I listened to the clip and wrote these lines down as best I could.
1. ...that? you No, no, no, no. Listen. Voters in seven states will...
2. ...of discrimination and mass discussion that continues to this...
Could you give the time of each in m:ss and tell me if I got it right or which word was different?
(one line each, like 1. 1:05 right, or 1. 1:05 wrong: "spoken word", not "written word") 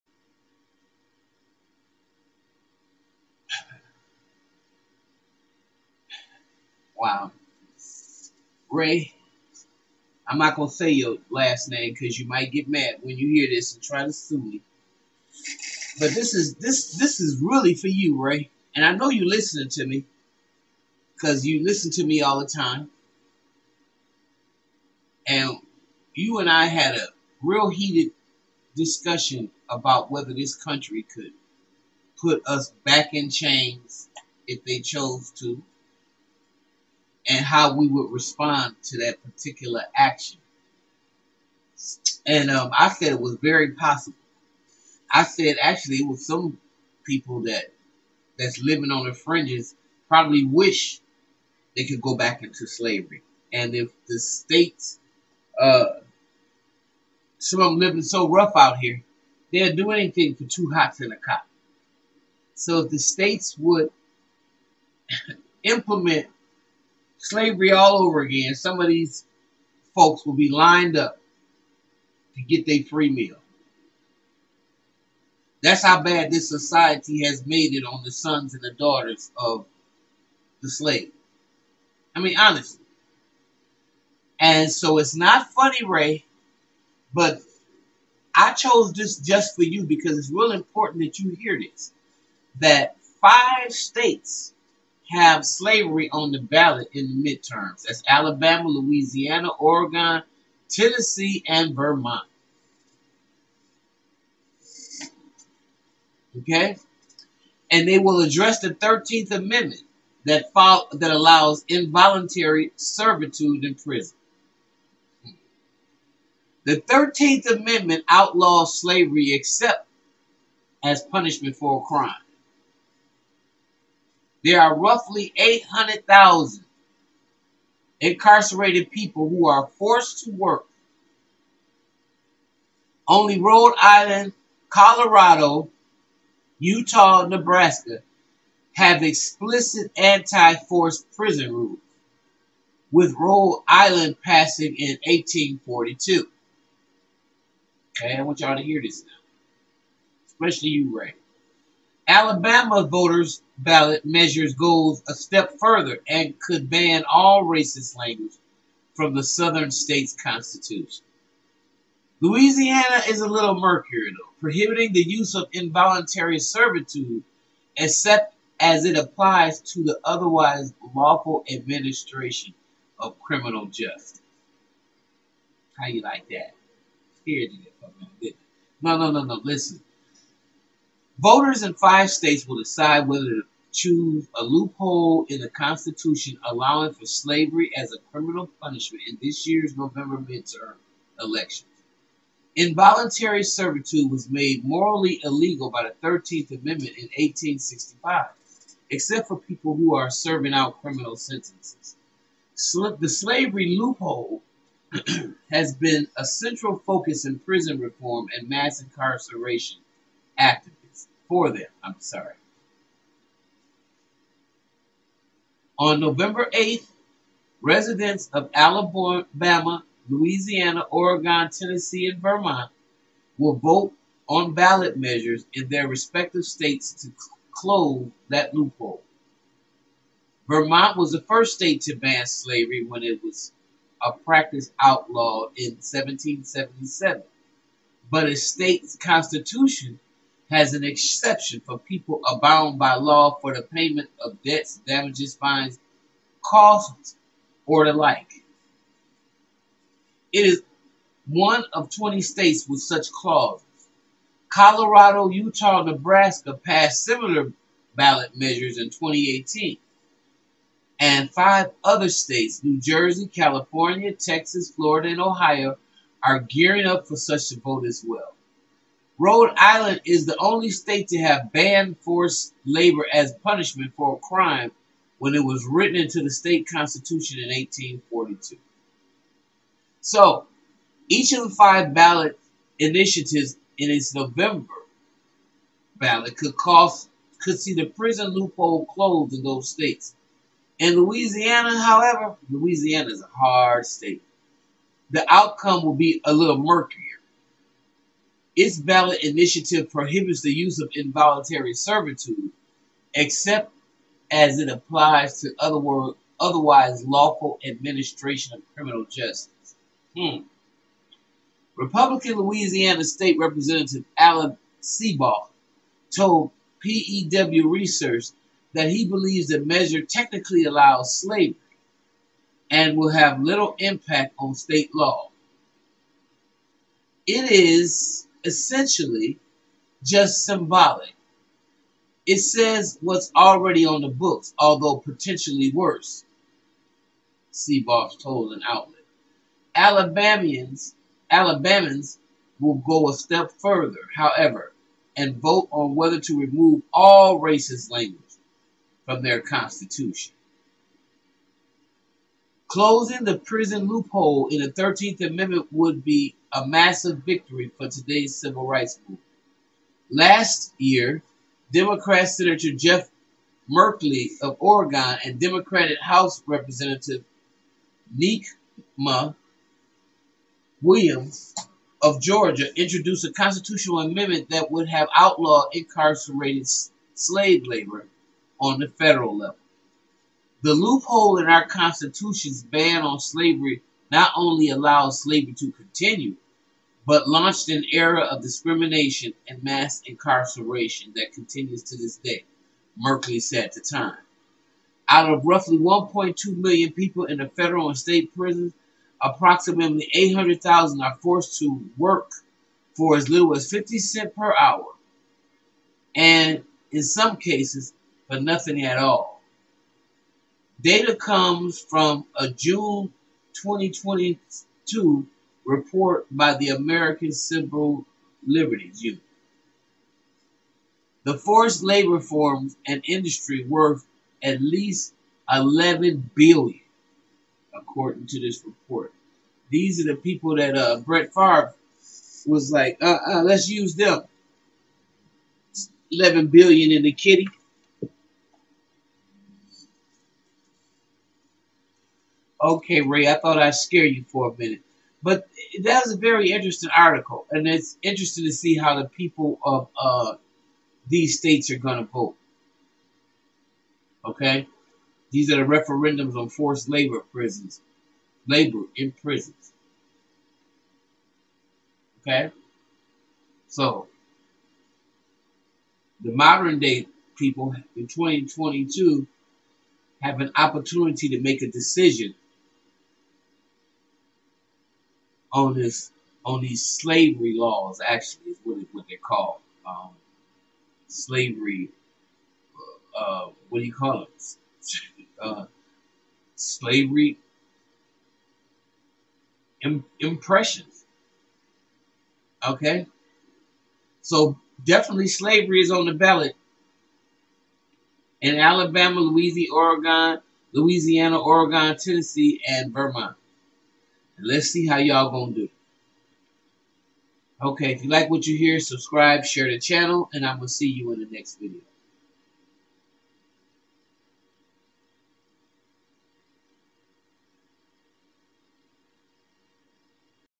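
1. 2:56 wrong: "five", not "seven"
2. 6:28 wrong: "incarceration", not "discussion".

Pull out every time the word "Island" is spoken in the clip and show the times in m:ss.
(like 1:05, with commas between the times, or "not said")
2:13, 2:23, 4:29.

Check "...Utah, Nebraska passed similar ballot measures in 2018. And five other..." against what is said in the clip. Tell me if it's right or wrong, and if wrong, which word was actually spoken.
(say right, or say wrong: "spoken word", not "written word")
right.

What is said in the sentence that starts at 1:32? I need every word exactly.
That five states have slavery on the ballot in the midterms.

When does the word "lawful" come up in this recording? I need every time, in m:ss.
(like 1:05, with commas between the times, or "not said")
2:50, 5:07.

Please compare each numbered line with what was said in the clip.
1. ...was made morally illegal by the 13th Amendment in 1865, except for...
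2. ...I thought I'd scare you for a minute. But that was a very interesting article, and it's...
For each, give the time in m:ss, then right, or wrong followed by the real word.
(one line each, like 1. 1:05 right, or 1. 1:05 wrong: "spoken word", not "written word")
1. 3:14 right
2. 7:23 right.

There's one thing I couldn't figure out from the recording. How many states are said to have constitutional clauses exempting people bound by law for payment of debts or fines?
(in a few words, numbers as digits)
20.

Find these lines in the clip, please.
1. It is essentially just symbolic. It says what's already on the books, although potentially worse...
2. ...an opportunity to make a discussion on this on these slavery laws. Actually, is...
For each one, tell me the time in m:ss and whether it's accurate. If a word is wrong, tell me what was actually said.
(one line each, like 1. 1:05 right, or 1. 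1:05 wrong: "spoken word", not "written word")
1. 5:27 right
2. 7:50 wrong: "decision", not "discussion".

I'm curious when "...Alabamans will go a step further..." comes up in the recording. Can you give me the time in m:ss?
5:41.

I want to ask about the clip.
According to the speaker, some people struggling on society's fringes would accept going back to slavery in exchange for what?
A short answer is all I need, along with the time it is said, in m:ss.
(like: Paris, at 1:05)
two hots and a cop, at 1:00.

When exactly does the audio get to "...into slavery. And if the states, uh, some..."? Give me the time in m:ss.
0:52.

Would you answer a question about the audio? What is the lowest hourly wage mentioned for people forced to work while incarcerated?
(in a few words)
50 cents.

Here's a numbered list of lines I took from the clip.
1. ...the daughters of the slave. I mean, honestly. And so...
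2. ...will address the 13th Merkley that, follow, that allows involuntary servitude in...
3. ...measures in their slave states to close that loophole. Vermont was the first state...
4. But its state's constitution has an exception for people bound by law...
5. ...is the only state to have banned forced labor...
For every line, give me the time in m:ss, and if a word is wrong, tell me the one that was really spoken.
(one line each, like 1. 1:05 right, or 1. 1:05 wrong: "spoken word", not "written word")
1. 1:18 right
2. 1:47 wrong: "Amendment", not "Merkley"
3. 3:44 wrong: "respective", not "slave"
4. 3:58 right
5. 4:30 right.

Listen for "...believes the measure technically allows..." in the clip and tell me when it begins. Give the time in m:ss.
5:19.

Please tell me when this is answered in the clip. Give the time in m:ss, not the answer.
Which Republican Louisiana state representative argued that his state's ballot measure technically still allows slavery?
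5:14.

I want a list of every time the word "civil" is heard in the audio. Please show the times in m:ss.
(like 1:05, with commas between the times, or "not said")
5:58, 6:57.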